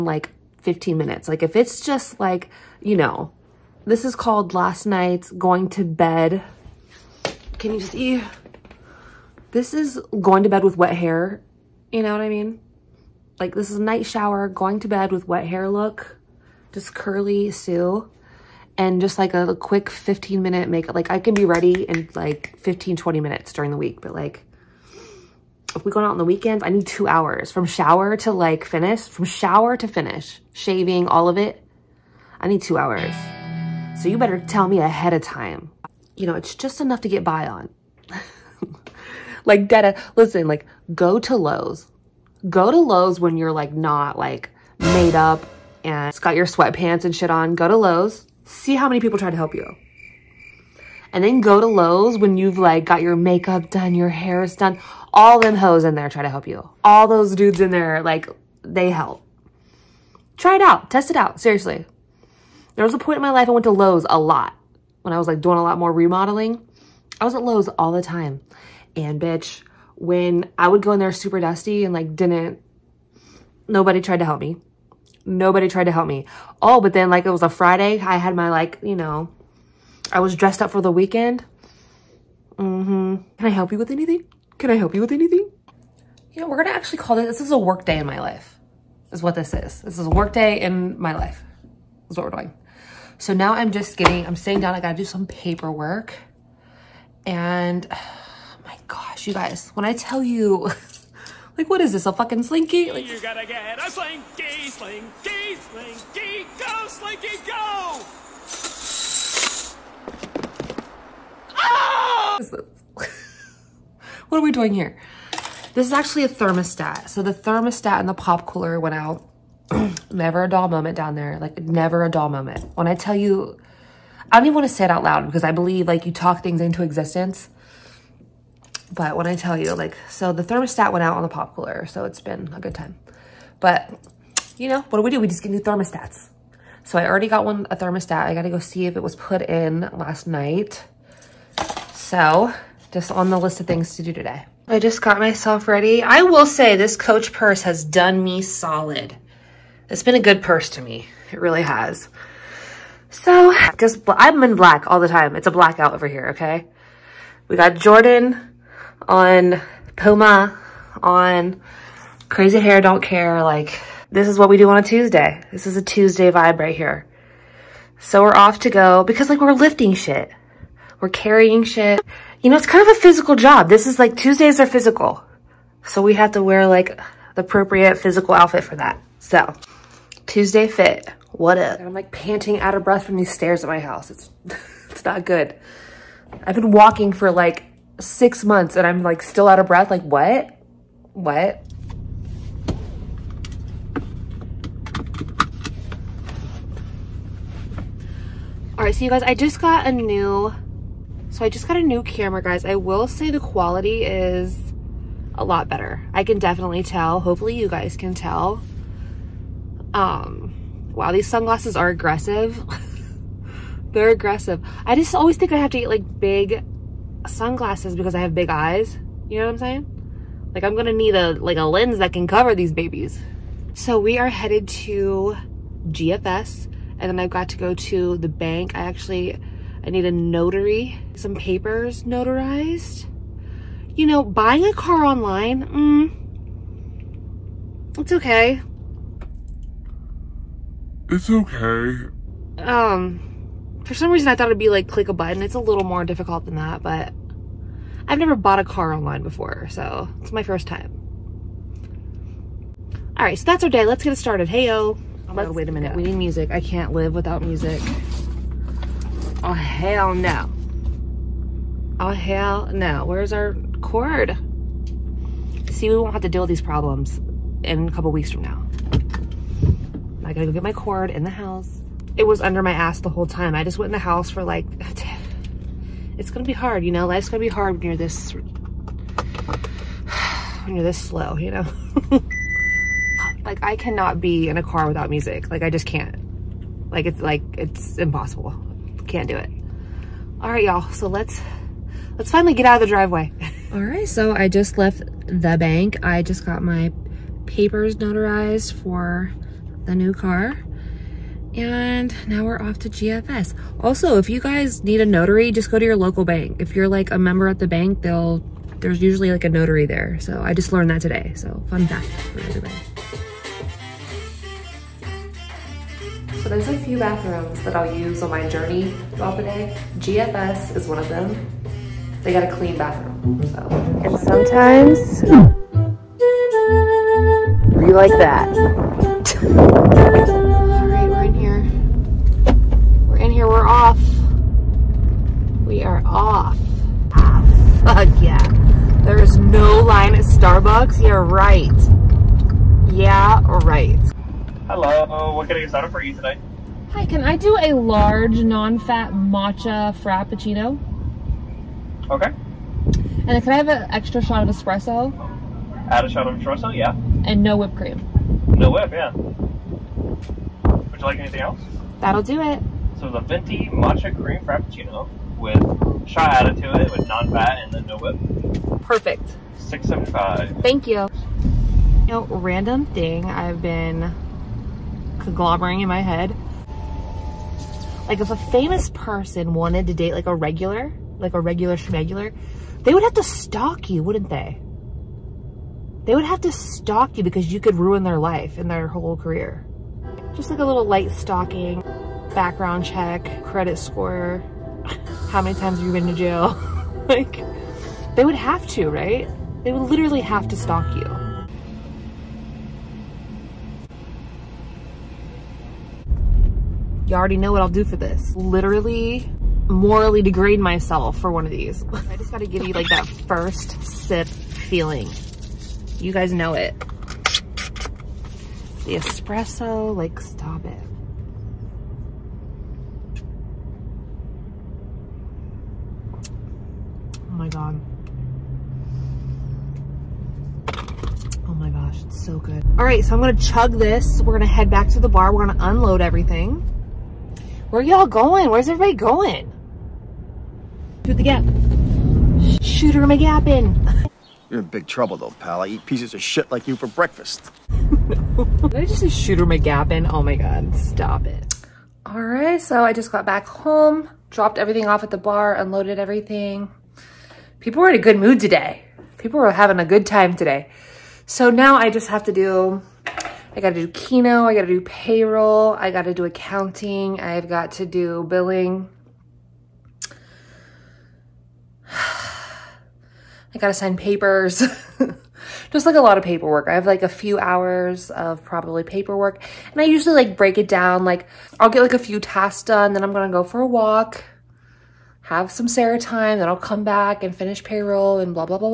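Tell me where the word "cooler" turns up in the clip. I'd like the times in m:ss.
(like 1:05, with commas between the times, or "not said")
1:58, 2:11.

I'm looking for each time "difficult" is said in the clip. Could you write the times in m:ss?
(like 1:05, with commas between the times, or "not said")
4:06.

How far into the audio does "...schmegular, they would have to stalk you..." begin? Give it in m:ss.
6:21.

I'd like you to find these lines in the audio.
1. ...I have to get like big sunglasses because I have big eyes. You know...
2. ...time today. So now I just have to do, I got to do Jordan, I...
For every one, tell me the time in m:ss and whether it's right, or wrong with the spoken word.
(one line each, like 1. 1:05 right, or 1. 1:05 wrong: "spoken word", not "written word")
1. 3:35 right
2. 7:40 wrong: "Keno", not "Jordan".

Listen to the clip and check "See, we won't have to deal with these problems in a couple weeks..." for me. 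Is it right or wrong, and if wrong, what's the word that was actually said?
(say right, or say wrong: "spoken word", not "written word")
right.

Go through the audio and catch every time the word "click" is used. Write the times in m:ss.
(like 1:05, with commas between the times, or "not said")
4:04.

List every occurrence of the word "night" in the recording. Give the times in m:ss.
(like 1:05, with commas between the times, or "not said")
0:04, 0:13, 2:20.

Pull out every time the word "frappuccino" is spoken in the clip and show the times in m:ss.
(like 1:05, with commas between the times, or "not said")
5:49, 6:04.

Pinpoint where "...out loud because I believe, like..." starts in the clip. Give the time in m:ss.
2:04.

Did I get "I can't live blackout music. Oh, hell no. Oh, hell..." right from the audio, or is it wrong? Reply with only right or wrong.
wrong.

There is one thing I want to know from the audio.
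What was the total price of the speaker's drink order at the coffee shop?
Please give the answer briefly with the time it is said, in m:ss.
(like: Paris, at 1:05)
675, at 6:09.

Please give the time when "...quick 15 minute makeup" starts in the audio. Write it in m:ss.
0:19.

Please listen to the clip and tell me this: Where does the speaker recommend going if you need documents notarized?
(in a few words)
Your local bank.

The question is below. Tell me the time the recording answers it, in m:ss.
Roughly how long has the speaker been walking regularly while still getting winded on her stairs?
3:07.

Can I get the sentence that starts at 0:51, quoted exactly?
And then go to Lowe's when you've like got your makeup done, your hair is done.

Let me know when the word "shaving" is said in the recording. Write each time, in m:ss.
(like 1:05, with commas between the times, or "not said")
0:30.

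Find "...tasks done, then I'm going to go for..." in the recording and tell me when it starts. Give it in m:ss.
8:02.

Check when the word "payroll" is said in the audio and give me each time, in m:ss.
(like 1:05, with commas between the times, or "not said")
7:44, 8:07.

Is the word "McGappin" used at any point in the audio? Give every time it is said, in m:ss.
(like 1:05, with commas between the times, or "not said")
7:23, 7:29.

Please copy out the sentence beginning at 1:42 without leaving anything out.
Like, you gotta get a slinky, slinky, slinky, go, slinky, go!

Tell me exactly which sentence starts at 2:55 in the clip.
So we have to wear like the appropriate physical outfit for that.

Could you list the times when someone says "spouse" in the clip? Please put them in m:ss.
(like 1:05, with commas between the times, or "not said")
not said.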